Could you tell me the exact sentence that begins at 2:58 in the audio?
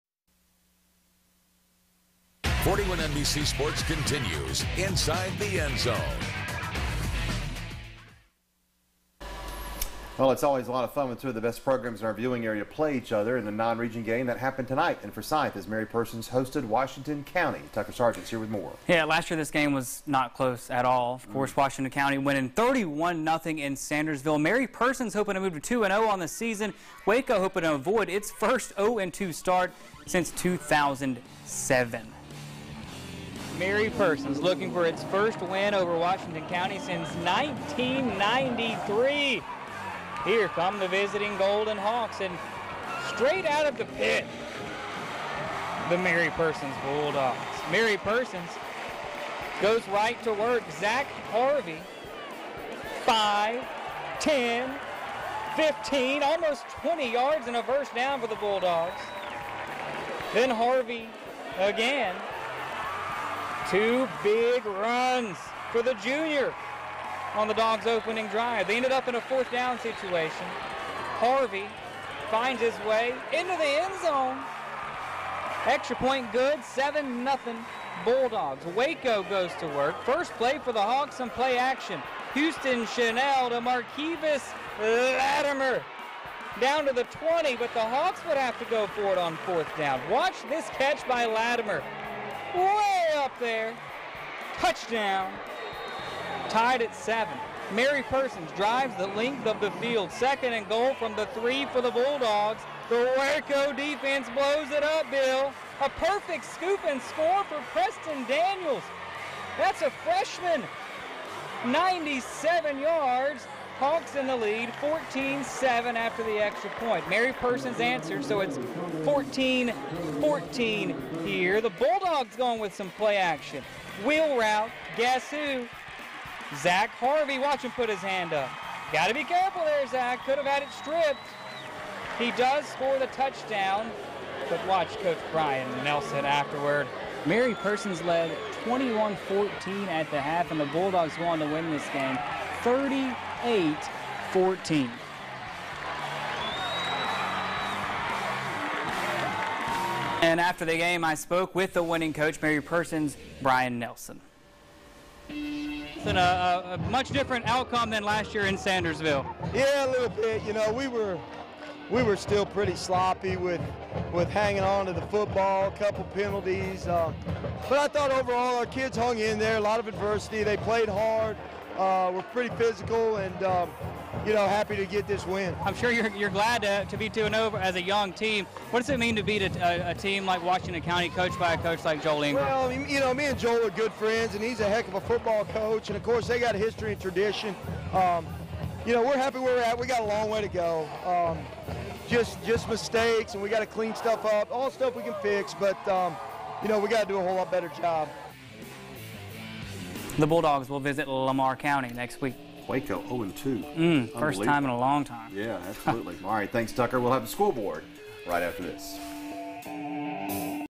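What does it mean to beat a, a, a, team like Washington County, coached by a coach like Joel Ingram?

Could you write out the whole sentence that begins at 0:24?
Mary Persons hoping to move to 2-0 on the season.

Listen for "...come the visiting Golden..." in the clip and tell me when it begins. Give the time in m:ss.
0:40.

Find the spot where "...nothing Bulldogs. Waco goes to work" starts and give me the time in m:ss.
1:17.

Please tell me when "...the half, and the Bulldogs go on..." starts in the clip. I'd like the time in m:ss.
2:20.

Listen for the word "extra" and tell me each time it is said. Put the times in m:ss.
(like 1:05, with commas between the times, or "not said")
1:15, 1:56.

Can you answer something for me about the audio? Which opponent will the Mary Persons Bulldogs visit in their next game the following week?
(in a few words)
Lamar County.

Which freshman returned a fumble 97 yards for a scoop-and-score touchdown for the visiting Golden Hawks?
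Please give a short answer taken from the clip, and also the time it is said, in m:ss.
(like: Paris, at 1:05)
Preston Daniels, at 1:47.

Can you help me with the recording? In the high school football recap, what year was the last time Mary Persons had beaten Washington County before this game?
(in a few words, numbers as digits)
1993.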